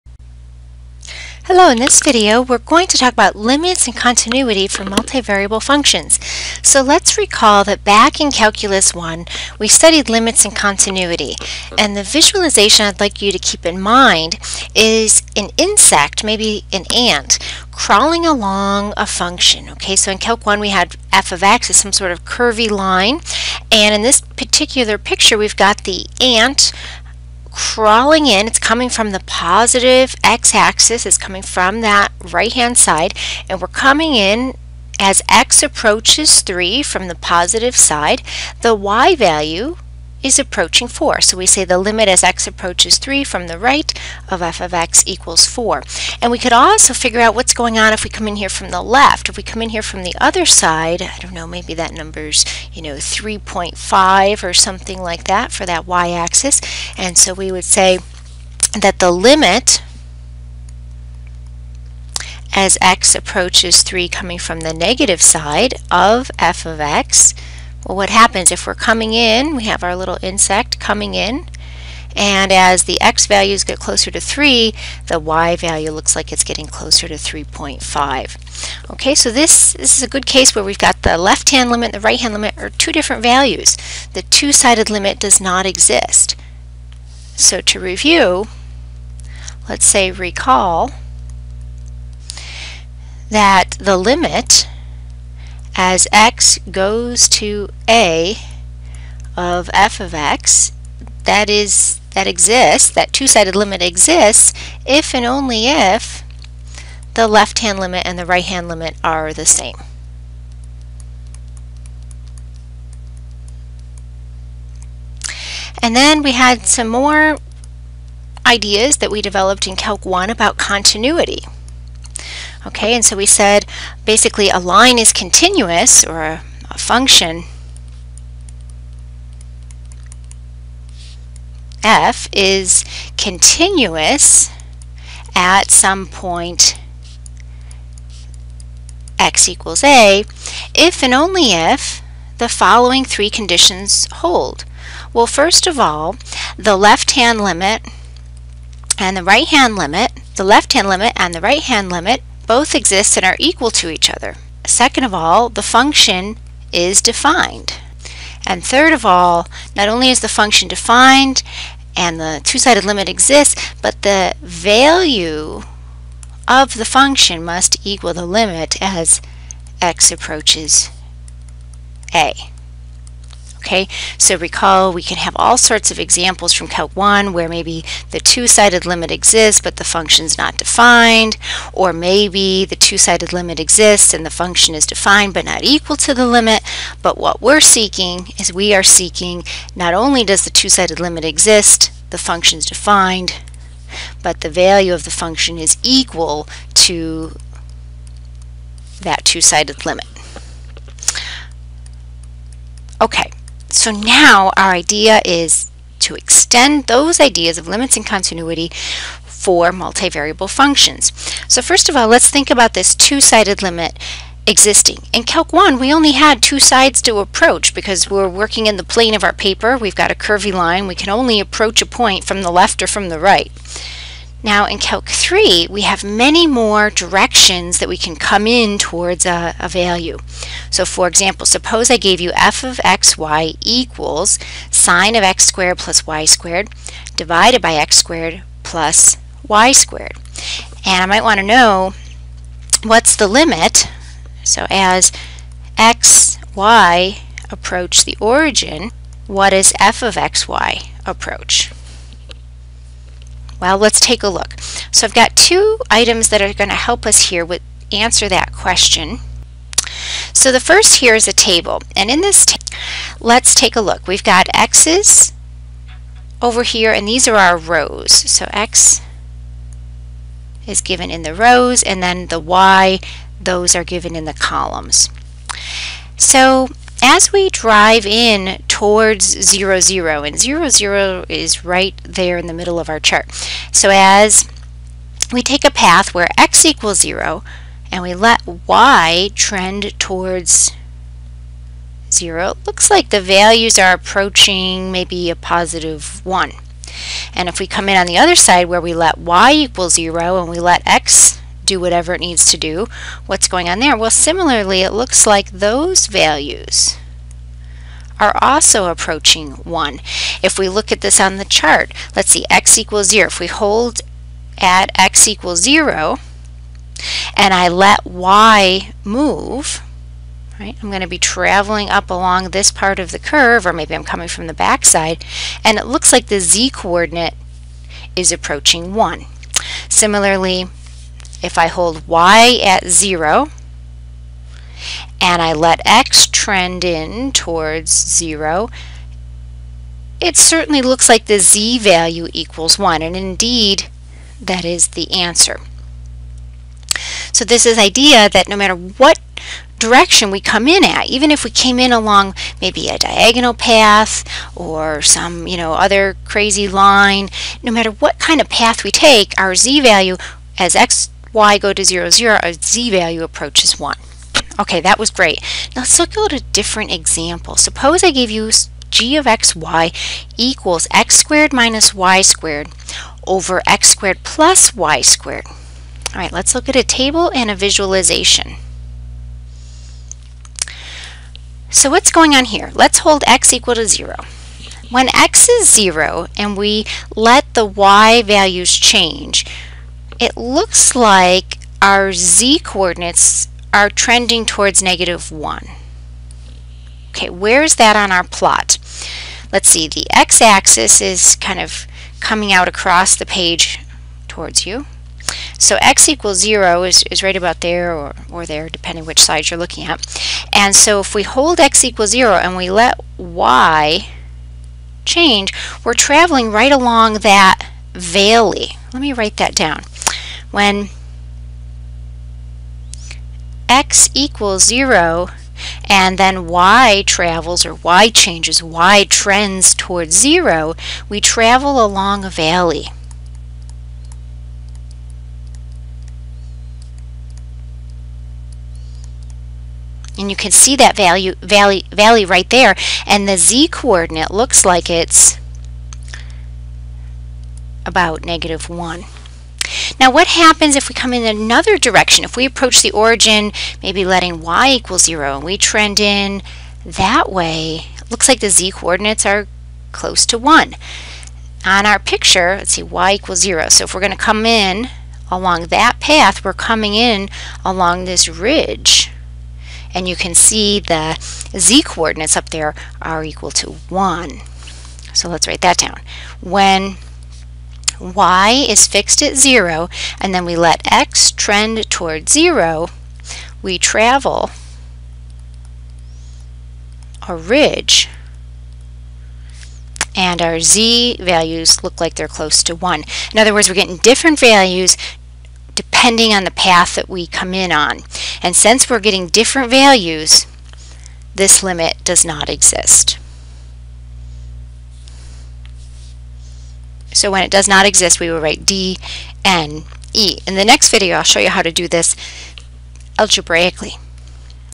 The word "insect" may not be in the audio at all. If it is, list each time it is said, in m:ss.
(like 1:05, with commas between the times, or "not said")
0:15, 1:10.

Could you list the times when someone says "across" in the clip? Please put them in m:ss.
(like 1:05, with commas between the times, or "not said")
6:42.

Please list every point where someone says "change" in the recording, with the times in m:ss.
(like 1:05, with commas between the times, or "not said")
6:28, 6:55, 7:08.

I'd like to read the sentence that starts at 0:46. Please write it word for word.
And we could also figure out what's going on if we come in here from the left.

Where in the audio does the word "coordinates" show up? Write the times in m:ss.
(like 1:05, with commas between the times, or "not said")
5:26, 6:32, 7:23, 7:38, 7:51.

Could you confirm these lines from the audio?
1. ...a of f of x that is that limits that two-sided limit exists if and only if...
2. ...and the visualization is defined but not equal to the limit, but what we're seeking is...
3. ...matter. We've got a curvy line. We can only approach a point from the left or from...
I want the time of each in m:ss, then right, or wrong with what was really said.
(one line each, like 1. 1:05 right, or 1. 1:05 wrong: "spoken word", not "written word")
1. 1:37 wrong: "exists", not "limits"
2. 3:04 wrong: "function", not "visualization"
3. 3:39 wrong: "paper", not "matter".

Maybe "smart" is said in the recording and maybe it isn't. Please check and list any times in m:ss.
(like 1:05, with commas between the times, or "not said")
not said.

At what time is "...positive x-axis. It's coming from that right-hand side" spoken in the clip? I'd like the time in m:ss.
0:29.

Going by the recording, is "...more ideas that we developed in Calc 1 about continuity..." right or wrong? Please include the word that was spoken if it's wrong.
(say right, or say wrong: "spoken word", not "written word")
right.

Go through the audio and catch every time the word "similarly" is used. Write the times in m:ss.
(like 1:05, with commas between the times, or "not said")
5:04, 5:29.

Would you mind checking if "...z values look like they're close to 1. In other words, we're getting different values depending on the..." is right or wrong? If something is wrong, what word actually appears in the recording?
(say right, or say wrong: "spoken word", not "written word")
right.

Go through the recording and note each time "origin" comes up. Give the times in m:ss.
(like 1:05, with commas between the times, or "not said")
4:08, 7:32.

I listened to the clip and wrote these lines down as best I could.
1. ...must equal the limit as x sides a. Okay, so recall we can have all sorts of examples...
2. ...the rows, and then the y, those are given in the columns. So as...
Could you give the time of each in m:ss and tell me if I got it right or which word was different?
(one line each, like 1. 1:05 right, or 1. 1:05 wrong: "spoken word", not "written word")
1. 2:47 wrong: "approaches", not "sides"
2. 4:31 right.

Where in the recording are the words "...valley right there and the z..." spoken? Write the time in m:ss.
7:21.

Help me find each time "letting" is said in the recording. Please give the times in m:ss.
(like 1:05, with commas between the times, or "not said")
7:34.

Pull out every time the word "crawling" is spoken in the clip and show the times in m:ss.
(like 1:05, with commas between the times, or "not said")
0:17, 0:27.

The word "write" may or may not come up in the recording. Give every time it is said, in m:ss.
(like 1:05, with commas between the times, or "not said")
6:59, 7:55, 8:28.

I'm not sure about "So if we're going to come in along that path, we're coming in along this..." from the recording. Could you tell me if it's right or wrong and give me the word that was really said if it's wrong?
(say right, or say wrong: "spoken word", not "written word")
right.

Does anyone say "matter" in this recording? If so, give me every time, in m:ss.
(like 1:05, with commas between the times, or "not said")
5:48, 5:57.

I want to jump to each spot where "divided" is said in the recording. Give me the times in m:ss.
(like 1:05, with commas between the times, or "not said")
3:57.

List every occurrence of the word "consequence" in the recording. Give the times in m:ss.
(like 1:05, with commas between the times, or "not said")
not said.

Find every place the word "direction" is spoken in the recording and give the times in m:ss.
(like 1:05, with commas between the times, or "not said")
3:46, 5:49, 7:31.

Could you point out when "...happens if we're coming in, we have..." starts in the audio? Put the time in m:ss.
1:08.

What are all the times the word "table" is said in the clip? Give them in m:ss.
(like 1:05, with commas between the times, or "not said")
4:21, 6:16.